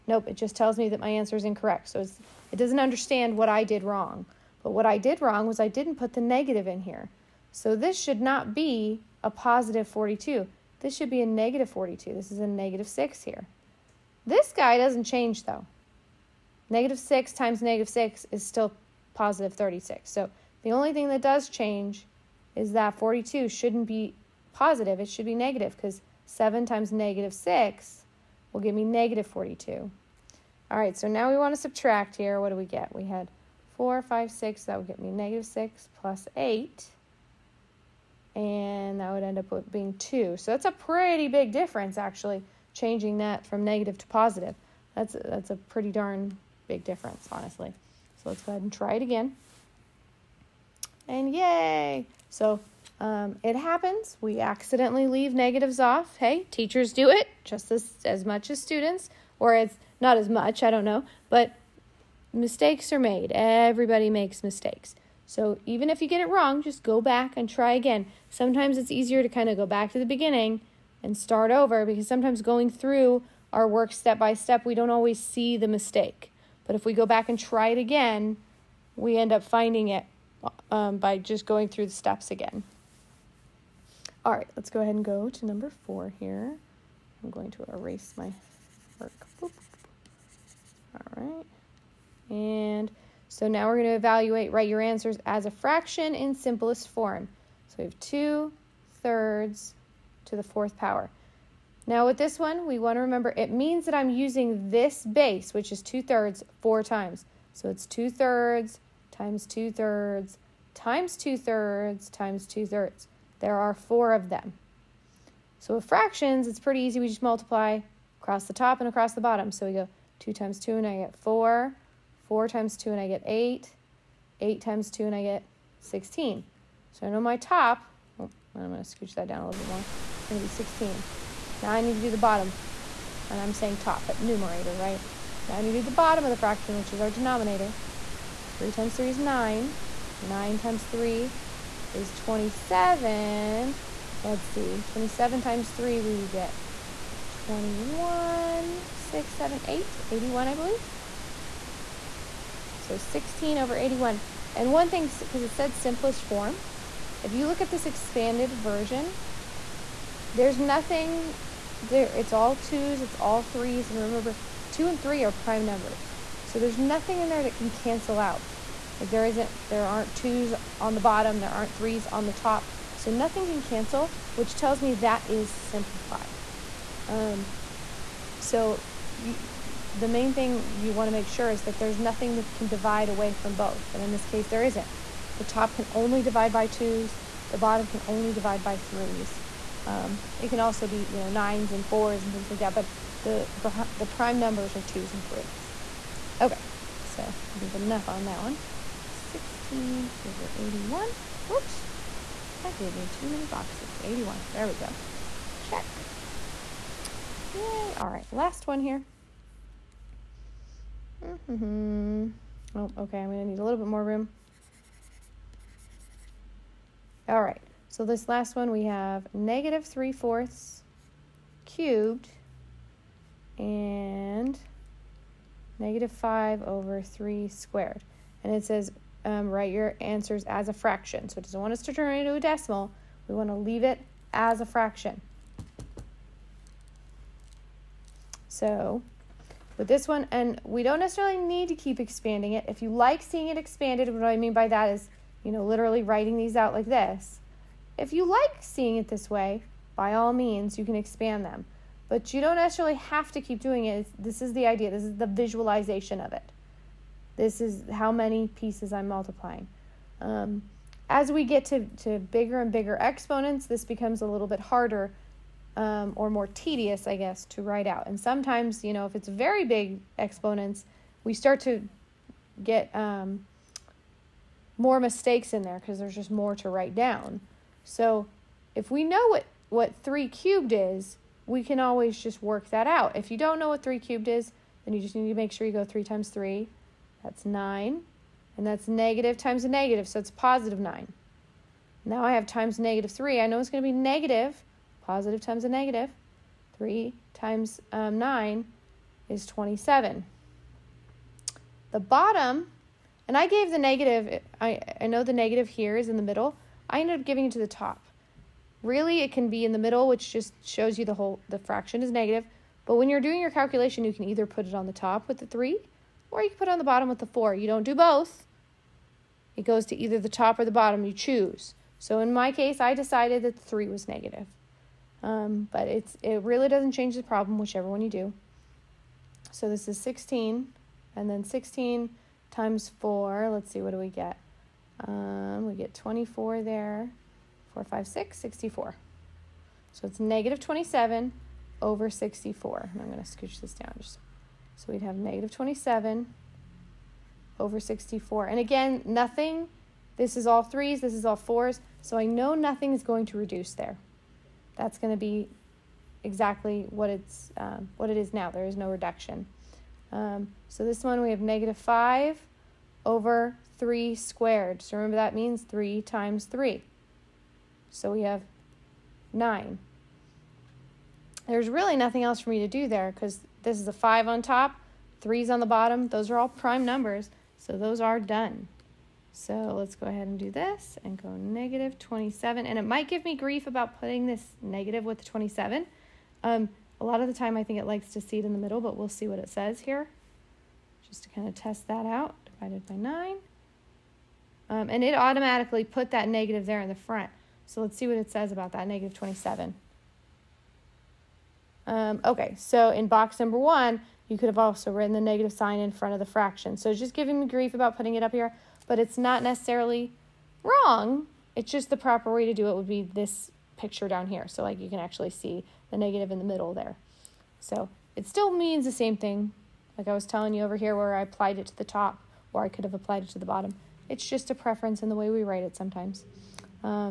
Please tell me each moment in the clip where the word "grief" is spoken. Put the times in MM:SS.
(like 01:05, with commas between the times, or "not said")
06:23, 06:47.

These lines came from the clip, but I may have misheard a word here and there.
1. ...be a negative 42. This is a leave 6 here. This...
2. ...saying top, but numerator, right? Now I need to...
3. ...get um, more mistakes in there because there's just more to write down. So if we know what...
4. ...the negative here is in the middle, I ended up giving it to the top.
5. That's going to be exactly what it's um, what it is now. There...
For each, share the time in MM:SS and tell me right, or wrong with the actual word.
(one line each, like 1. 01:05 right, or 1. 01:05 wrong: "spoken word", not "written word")
1. 00:11 wrong: "negative", not "leave"
2. 02:13 right
3. 04:32 right
4. 05:05 right
5. 05:54 right.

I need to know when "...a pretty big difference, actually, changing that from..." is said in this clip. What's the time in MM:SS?
00:40.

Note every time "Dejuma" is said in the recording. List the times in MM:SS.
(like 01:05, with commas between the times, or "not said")
not said.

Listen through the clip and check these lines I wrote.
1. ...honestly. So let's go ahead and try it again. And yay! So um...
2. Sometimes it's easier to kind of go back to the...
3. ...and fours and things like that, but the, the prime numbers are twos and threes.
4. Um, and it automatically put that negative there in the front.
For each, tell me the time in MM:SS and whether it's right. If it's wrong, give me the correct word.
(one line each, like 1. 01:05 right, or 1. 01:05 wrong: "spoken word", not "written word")
1. 00:47 right
2. 01:08 right
3. 03:11 right
4. 06:34 right.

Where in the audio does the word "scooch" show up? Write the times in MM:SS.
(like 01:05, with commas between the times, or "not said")
02:08, 05:43.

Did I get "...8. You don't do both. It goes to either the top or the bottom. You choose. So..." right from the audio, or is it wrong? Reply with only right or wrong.
wrong.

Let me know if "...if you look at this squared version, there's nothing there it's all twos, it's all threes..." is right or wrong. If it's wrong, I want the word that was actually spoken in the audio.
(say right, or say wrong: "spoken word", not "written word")
wrong: "expanded", not "squared".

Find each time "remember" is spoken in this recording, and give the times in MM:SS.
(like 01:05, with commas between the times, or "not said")
01:43, 02:43, 06:04.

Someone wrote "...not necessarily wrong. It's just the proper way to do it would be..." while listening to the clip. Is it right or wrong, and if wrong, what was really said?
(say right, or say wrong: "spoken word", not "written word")
right.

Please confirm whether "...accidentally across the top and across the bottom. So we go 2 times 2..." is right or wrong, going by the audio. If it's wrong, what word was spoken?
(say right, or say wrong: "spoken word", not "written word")
wrong: "multiply", not "accidentally".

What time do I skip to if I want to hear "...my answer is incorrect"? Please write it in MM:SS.
00:01.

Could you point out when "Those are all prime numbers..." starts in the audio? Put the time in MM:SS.
06:16.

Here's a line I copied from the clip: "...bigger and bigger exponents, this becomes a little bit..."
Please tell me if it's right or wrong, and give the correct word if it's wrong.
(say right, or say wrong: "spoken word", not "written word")
right.